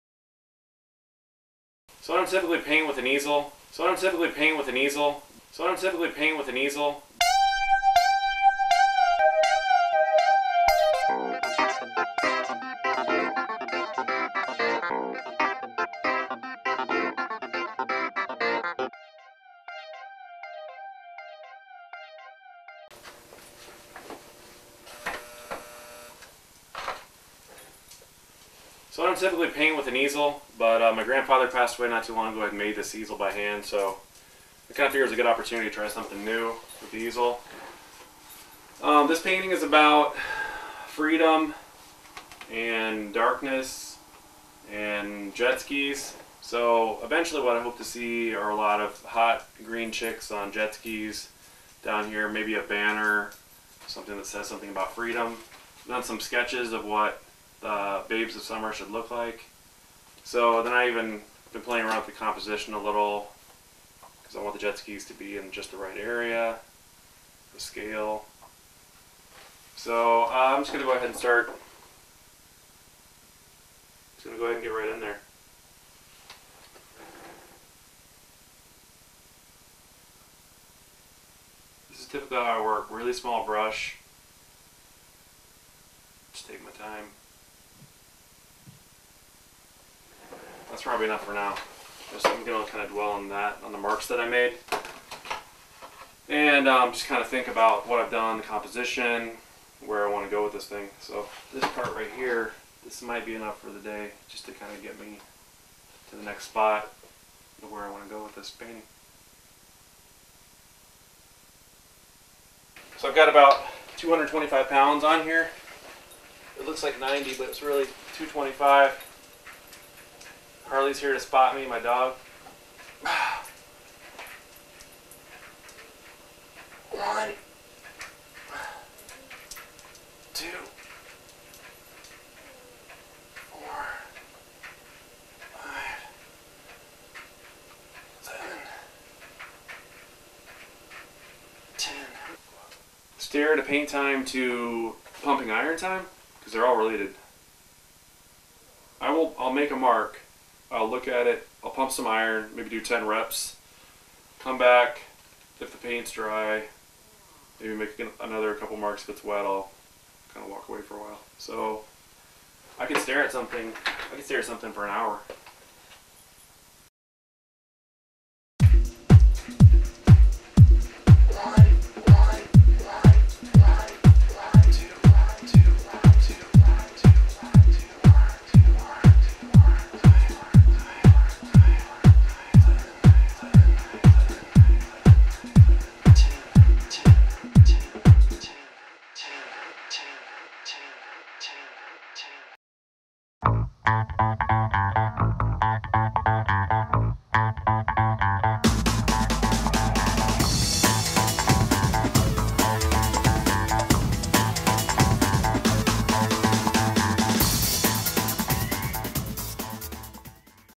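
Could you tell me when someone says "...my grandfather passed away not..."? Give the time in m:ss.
0:30.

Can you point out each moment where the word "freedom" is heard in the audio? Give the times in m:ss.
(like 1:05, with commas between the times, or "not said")
0:40, 0:54.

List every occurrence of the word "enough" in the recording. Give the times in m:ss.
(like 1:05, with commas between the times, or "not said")
1:31, 1:43.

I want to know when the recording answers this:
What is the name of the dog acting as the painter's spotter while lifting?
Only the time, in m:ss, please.
2:00.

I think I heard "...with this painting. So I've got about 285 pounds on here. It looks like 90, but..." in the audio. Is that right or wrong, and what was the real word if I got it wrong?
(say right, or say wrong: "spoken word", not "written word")
wrong: "225", not "285".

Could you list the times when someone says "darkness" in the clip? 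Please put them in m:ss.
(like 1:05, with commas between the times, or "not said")
0:43.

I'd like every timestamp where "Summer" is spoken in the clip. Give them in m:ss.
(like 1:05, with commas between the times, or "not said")
0:58.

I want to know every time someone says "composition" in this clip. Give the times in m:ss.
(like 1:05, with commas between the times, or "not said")
1:02, 1:38.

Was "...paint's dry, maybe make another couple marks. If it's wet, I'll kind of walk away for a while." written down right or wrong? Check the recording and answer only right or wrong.
right.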